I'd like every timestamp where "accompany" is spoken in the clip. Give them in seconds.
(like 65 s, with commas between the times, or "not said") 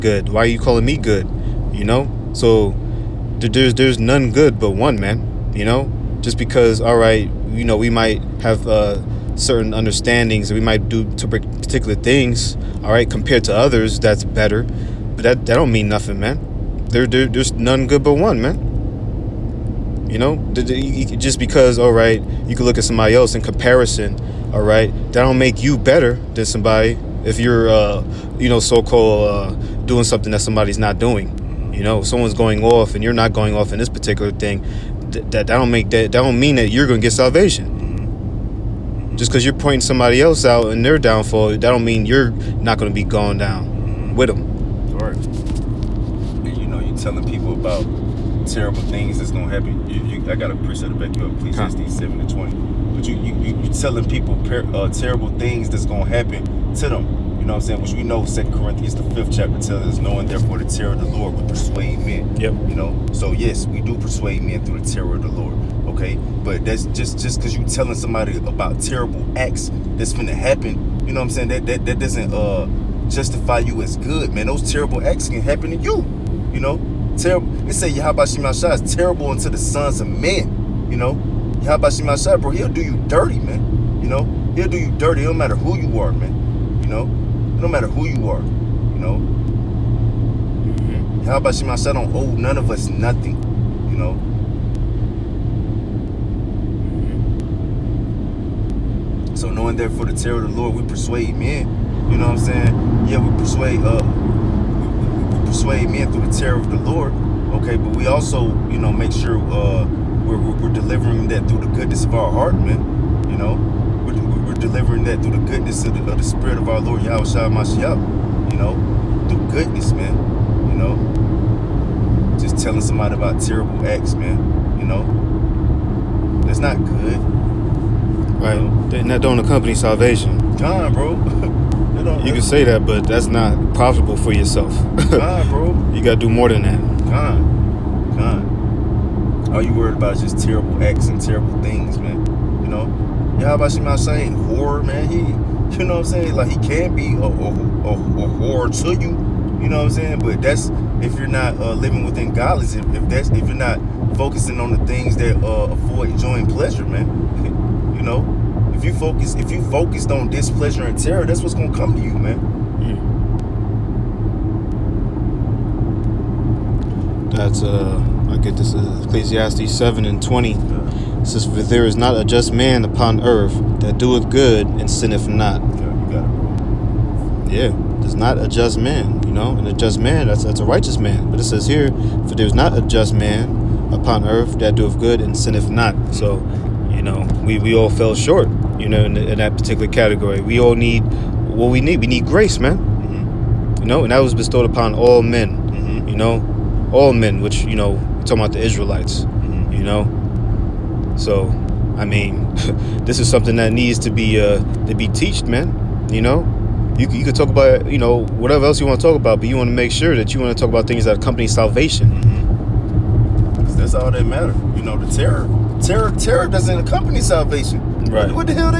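129 s, 211 s, 216 s.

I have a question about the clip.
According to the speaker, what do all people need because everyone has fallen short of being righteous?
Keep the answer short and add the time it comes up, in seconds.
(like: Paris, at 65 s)
Grace, at 192 s.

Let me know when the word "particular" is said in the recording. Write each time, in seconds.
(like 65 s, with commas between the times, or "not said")
11 s, 33 s, 189 s.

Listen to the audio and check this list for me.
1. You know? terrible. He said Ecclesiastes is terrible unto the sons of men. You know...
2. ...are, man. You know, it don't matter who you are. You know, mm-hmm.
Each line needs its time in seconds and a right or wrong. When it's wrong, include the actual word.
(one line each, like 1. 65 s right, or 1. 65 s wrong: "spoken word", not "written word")
1. 76 s wrong: "Yahabashimashah", not "Ecclesiastes"
2. 85 s right.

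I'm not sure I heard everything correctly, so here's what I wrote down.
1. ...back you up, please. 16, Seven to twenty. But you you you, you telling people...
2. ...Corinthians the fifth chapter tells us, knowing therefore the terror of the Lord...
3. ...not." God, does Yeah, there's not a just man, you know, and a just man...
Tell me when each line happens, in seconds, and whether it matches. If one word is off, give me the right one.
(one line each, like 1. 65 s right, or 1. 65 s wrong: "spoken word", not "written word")
1. 50 s right
2. 58 s right
3. 175 s wrong: "Yeah", not "God".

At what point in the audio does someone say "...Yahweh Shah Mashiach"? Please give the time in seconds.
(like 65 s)
117 s.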